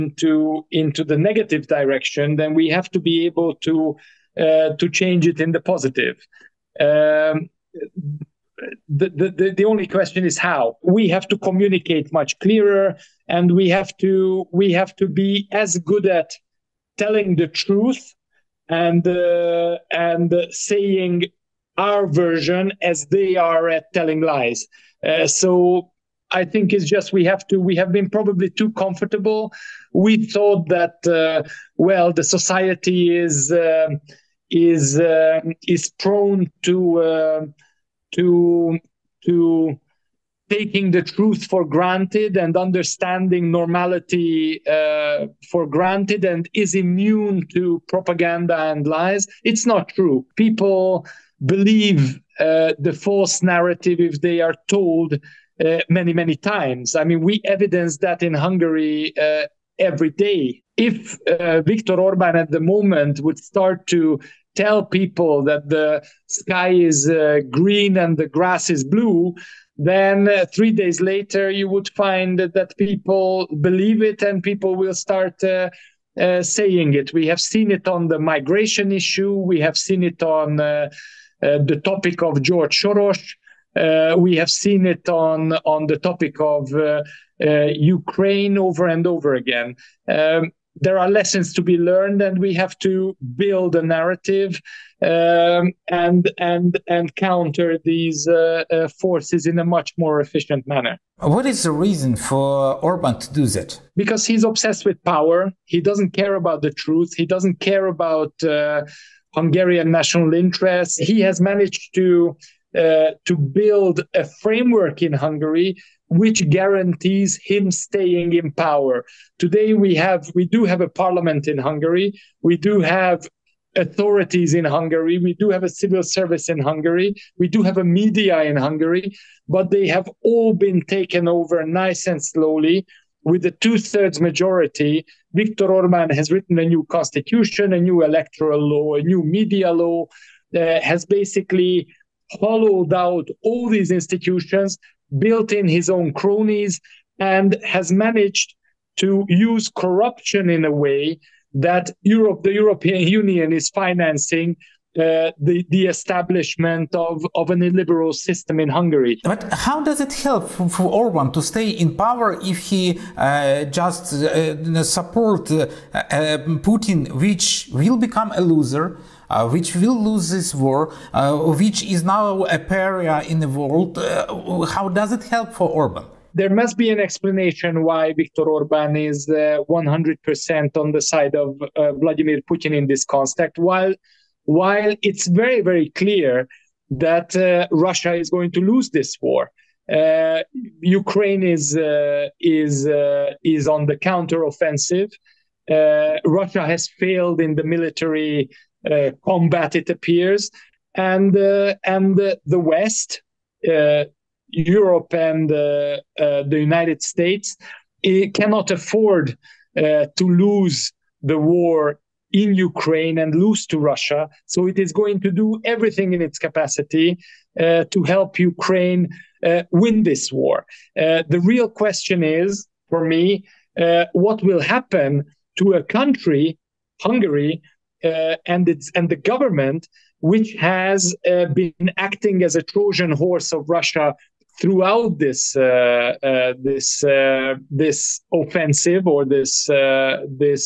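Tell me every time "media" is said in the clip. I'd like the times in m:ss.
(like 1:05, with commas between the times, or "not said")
2:07, 2:19.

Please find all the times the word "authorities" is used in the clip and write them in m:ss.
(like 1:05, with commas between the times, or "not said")
2:03.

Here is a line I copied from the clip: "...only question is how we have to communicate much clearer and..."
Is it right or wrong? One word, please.
right.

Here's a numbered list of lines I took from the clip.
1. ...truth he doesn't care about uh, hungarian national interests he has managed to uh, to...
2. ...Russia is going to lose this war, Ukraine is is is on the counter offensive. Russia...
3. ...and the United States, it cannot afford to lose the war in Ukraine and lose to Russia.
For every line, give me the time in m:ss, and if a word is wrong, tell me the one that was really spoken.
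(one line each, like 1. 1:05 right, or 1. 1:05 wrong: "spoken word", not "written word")
1. 1:46 right
2. 3:07 right
3. 3:25 right.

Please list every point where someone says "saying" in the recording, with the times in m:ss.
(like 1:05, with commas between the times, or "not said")
0:20, 1:16.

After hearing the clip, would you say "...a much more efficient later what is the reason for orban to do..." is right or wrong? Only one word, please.
wrong.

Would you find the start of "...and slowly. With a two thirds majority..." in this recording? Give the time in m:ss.
2:12.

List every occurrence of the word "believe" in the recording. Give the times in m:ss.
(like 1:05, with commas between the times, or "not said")
0:51, 1:13.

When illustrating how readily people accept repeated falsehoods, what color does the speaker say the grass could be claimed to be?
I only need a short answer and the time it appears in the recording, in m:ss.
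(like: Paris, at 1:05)
blue, at 1:08.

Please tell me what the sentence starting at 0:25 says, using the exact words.
Uh, so I think it's just we have to we have been probably too comfortable.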